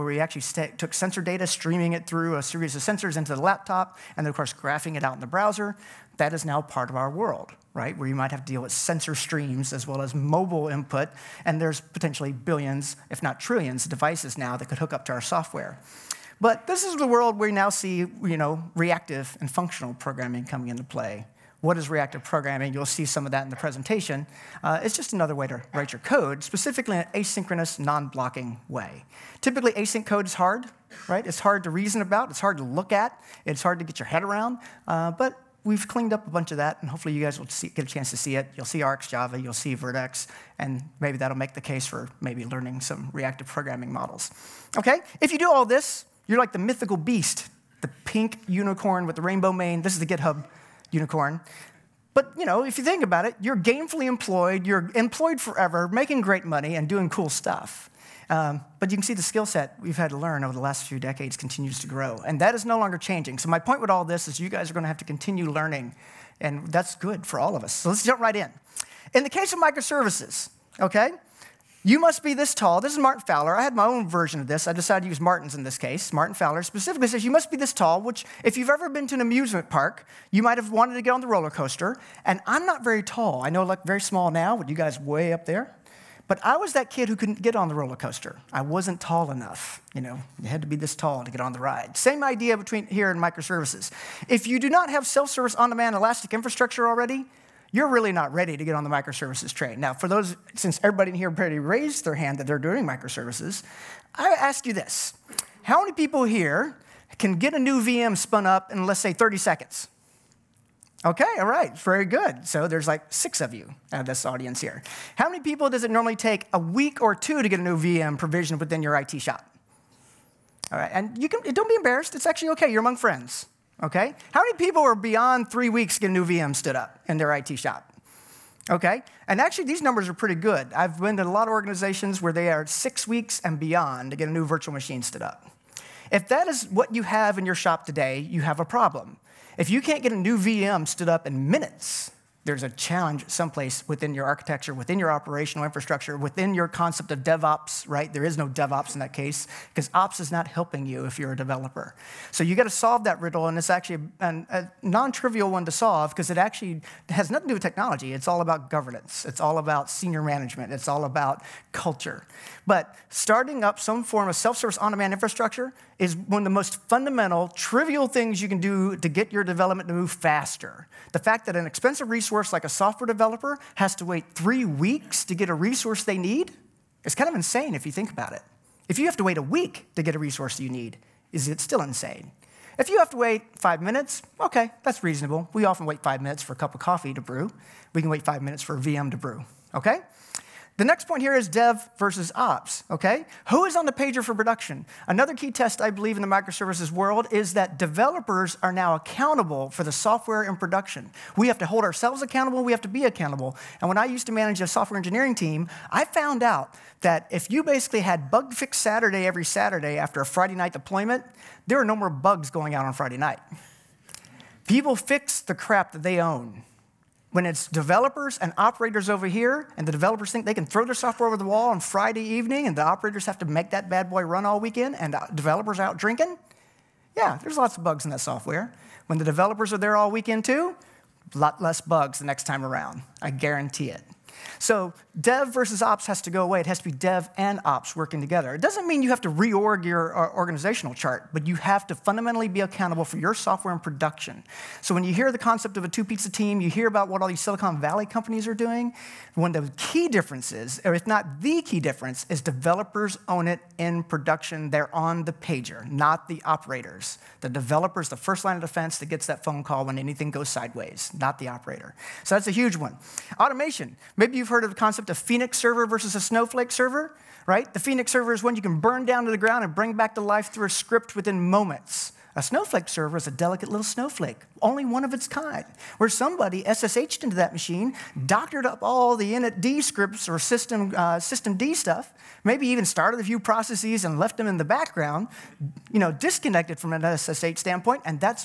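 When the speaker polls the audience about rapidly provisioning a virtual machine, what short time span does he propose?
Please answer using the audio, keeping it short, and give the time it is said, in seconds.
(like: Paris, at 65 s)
30 seconds, at 109 s.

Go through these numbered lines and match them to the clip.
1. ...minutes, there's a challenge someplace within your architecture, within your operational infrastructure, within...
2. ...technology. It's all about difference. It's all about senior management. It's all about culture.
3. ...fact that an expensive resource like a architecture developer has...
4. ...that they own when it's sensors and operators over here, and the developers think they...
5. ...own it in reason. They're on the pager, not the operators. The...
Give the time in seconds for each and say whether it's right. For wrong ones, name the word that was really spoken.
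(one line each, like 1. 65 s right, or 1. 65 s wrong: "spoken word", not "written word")
1. 141 s right
2. 157 s wrong: "governance", not "difference"
3. 171 s wrong: "software", not "architecture"
4. 215 s wrong: "developers", not "sensors"
5. 253 s wrong: "production", not "reason".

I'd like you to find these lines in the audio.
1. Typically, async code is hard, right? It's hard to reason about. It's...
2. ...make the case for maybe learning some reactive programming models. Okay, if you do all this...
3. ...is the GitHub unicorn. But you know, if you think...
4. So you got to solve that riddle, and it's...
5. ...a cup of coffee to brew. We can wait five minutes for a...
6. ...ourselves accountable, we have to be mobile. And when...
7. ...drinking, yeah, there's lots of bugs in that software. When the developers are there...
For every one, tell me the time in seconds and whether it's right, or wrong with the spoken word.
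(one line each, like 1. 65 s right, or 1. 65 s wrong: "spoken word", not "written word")
1. 29 s right
2. 41 s right
3. 49 s right
4. 152 s right
5. 186 s right
6. 201 s wrong: "accountable", not "mobile"
7. 225 s right.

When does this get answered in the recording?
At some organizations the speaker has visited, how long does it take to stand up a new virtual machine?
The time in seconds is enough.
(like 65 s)
132 s.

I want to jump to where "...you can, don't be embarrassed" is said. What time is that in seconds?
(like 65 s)
121 s.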